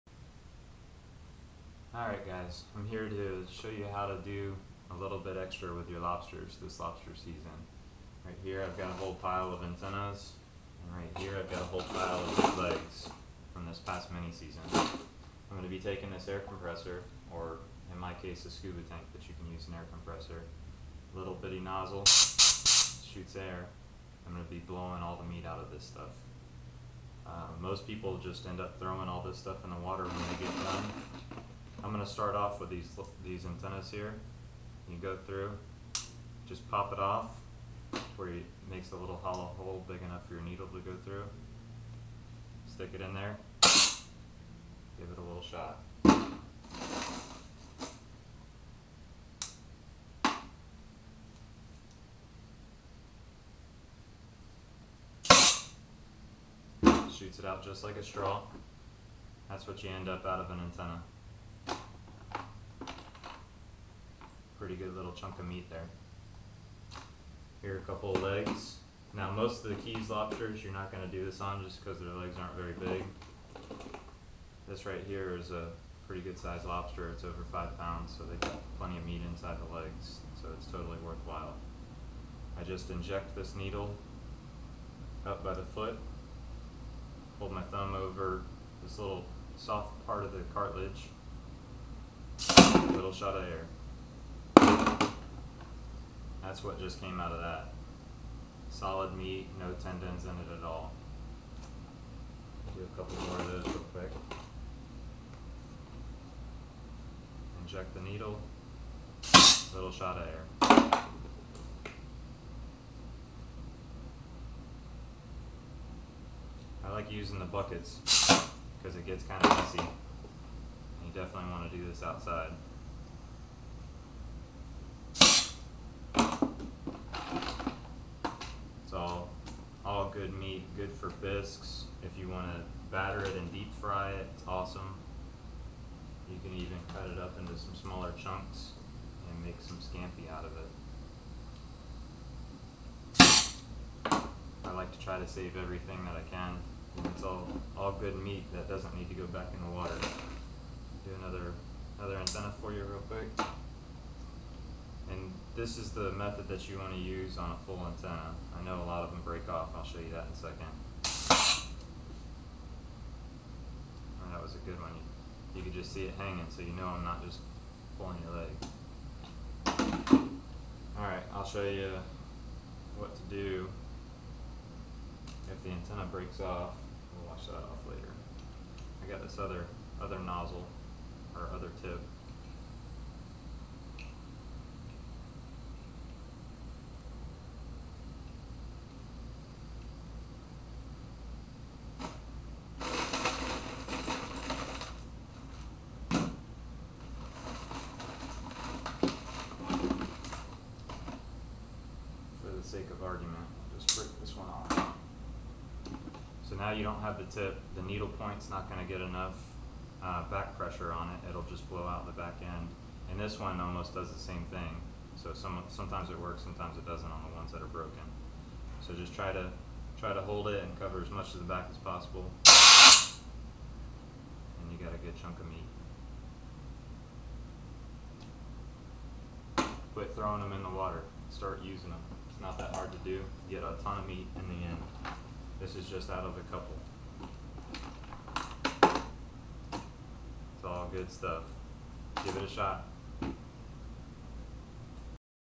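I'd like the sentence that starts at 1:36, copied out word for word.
That's what just came out of that.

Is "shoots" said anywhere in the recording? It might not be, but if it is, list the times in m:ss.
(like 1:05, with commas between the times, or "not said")
0:22, 0:57.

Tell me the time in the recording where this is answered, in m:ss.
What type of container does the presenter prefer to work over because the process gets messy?
1:57.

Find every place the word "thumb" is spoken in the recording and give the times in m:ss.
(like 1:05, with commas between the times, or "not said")
1:27.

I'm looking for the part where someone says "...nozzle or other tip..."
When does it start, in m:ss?
3:00.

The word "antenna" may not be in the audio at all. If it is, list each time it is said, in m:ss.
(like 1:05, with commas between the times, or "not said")
0:09, 0:33, 1:00, 2:32, 2:37, 2:55.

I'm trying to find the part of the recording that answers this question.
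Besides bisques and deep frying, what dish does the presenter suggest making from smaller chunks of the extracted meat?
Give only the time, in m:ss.
2:19.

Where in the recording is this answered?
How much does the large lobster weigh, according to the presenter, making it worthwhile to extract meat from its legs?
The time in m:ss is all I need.
1:17.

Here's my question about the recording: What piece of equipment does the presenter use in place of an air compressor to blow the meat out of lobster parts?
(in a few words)
scuba tank.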